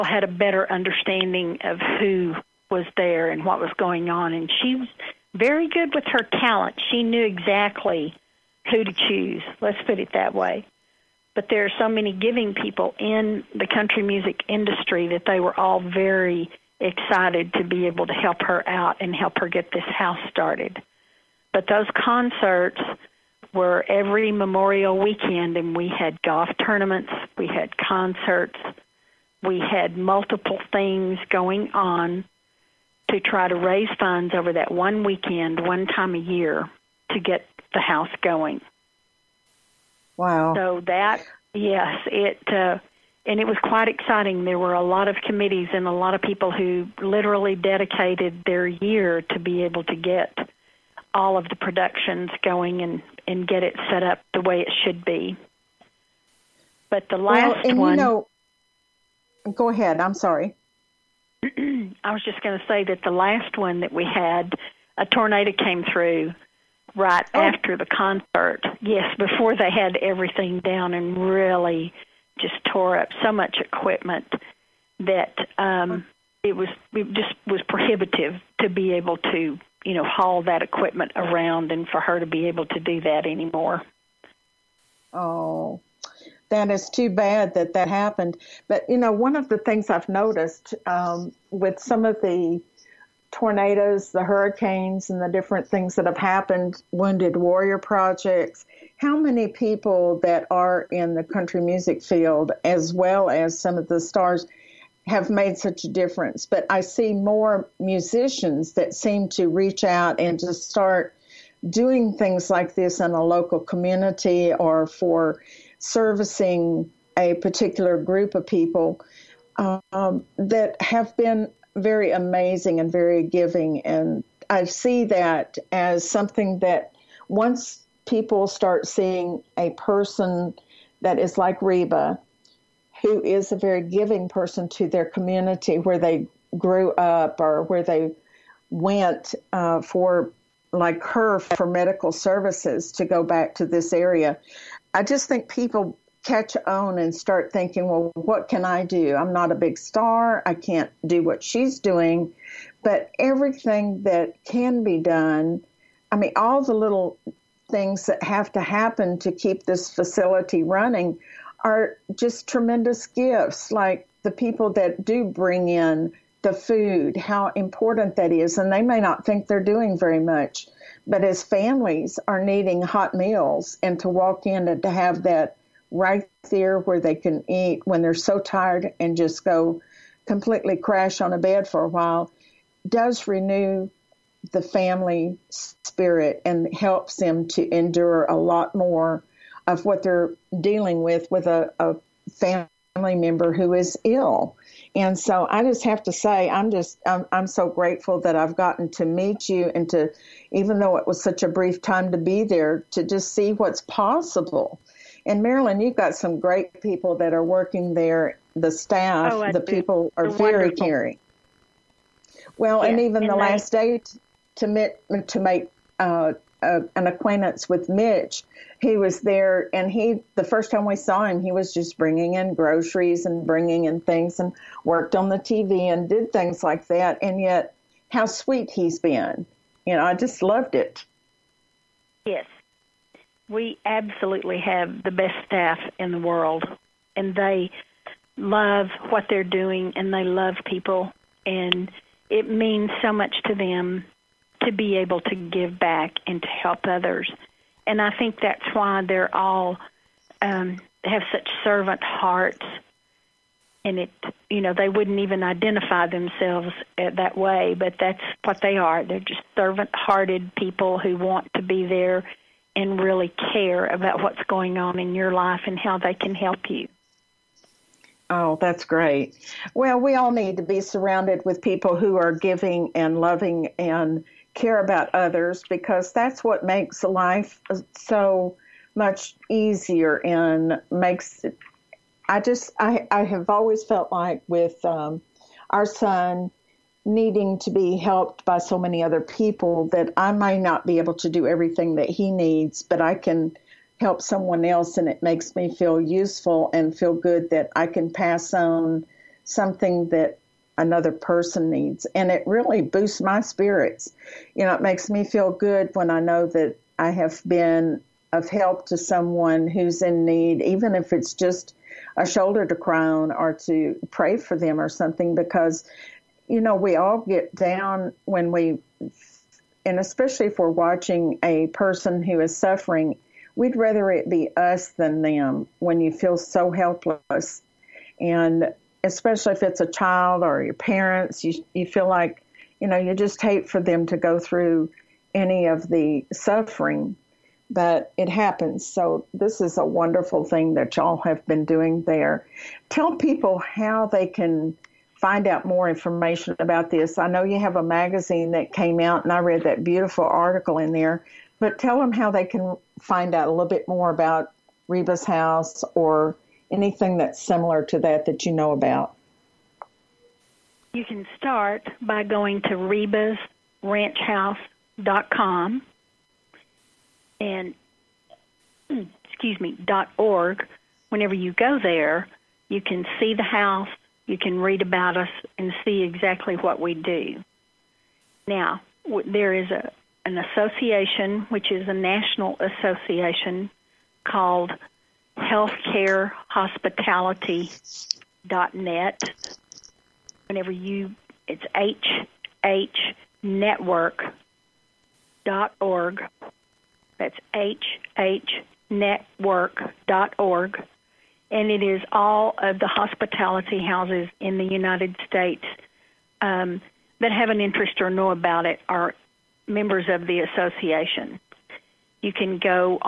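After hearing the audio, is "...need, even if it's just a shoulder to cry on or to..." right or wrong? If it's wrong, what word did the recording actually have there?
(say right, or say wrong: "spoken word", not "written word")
right.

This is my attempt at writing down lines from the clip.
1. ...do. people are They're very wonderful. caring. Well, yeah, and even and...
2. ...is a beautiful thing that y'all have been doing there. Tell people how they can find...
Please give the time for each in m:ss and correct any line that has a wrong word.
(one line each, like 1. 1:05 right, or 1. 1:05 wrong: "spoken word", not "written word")
1. 3:29 right
2. 5:39 wrong: "wonderful", not "beautiful".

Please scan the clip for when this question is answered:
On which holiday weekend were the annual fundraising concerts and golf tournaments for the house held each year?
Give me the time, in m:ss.
0:24.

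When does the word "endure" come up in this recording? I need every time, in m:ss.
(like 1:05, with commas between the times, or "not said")
3:07.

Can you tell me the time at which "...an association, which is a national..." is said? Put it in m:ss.
6:20.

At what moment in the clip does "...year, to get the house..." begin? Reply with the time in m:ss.
0:36.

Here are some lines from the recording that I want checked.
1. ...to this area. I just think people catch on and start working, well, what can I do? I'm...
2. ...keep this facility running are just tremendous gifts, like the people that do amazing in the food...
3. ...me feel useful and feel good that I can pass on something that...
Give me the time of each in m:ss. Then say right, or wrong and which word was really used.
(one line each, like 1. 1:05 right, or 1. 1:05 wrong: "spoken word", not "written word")
1. 2:23 wrong: "thinking", not "working"
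2. 2:39 wrong: "bring", not "amazing"
3. 4:55 right.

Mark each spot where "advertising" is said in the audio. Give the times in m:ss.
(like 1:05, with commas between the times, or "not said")
not said.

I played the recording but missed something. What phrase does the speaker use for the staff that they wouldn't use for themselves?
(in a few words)
servant hearts.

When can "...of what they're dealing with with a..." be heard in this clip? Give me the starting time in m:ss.
3:09.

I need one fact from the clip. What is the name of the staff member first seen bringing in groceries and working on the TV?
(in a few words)
Mitch.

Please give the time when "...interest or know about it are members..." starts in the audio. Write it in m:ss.
6:47.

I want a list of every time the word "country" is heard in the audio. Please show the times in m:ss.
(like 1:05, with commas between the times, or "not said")
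0:13, 1:41.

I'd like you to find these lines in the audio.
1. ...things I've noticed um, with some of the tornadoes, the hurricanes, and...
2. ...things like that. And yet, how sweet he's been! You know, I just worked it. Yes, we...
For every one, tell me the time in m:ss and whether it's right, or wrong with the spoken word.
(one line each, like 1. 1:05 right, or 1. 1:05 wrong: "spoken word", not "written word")
1. 1:29 right
2. 3:46 wrong: "loved", not "worked".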